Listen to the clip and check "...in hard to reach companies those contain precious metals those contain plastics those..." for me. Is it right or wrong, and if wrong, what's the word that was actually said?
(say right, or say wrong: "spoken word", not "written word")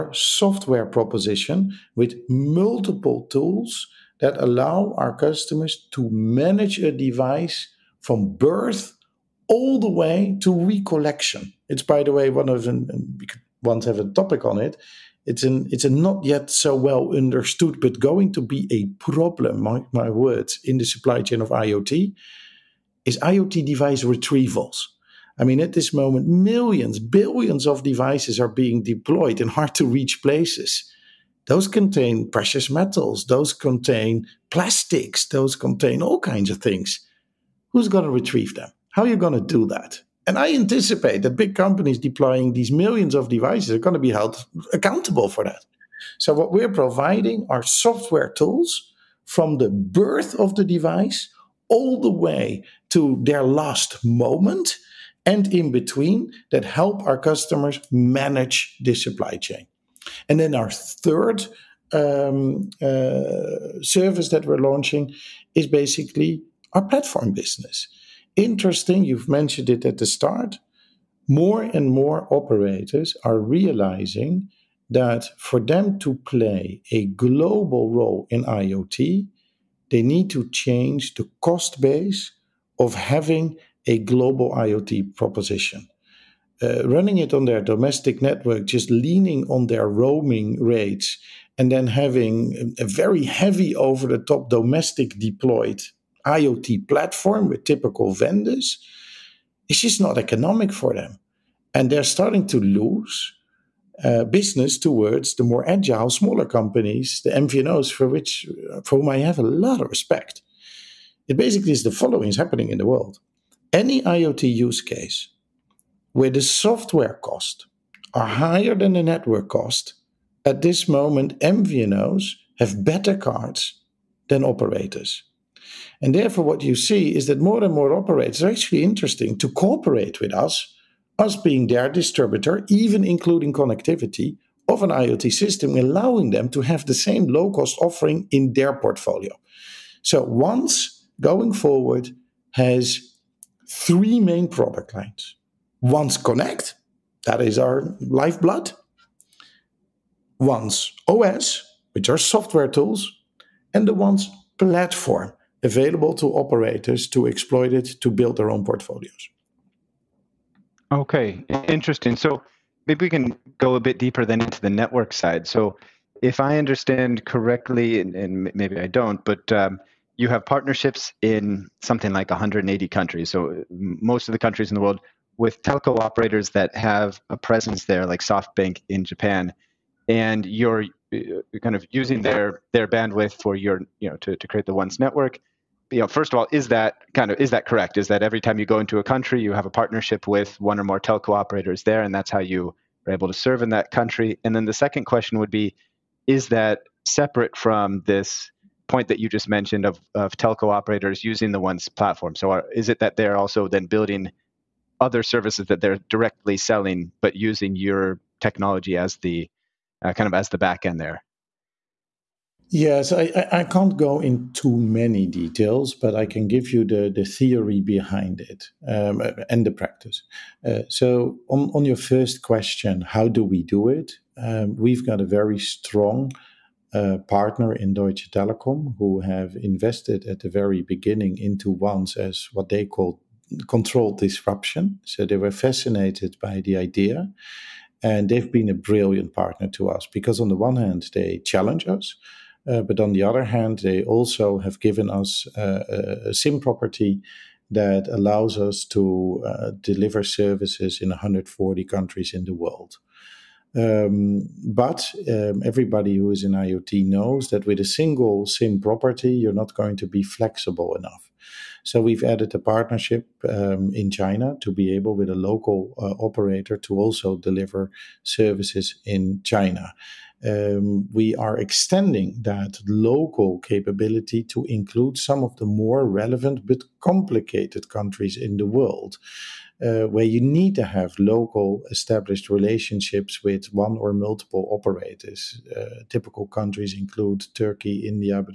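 wrong: "places", not "companies".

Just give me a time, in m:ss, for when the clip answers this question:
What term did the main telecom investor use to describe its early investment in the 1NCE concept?
3:53.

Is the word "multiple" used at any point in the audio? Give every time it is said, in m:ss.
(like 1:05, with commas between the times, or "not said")
0:02, 4:44.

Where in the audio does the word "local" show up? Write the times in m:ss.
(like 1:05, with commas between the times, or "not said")
4:25, 4:32, 4:41.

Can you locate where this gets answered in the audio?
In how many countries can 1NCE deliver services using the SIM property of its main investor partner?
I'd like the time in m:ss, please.
4:11.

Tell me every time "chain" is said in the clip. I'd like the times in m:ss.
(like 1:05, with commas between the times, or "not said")
0:21, 0:59.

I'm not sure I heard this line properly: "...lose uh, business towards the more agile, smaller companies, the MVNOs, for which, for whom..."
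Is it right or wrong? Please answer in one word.
right.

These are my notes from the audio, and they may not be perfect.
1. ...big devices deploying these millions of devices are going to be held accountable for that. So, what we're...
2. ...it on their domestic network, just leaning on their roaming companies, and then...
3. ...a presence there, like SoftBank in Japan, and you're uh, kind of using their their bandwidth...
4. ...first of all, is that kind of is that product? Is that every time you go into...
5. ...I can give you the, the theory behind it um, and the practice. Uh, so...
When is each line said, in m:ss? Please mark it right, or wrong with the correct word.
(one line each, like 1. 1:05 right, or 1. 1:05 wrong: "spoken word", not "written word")
1. 0:41 wrong: "companies", not "devices"
2. 1:27 wrong: "rates", not "companies"
3. 2:57 right
4. 3:06 wrong: "correct", not "product"
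5. 3:36 right.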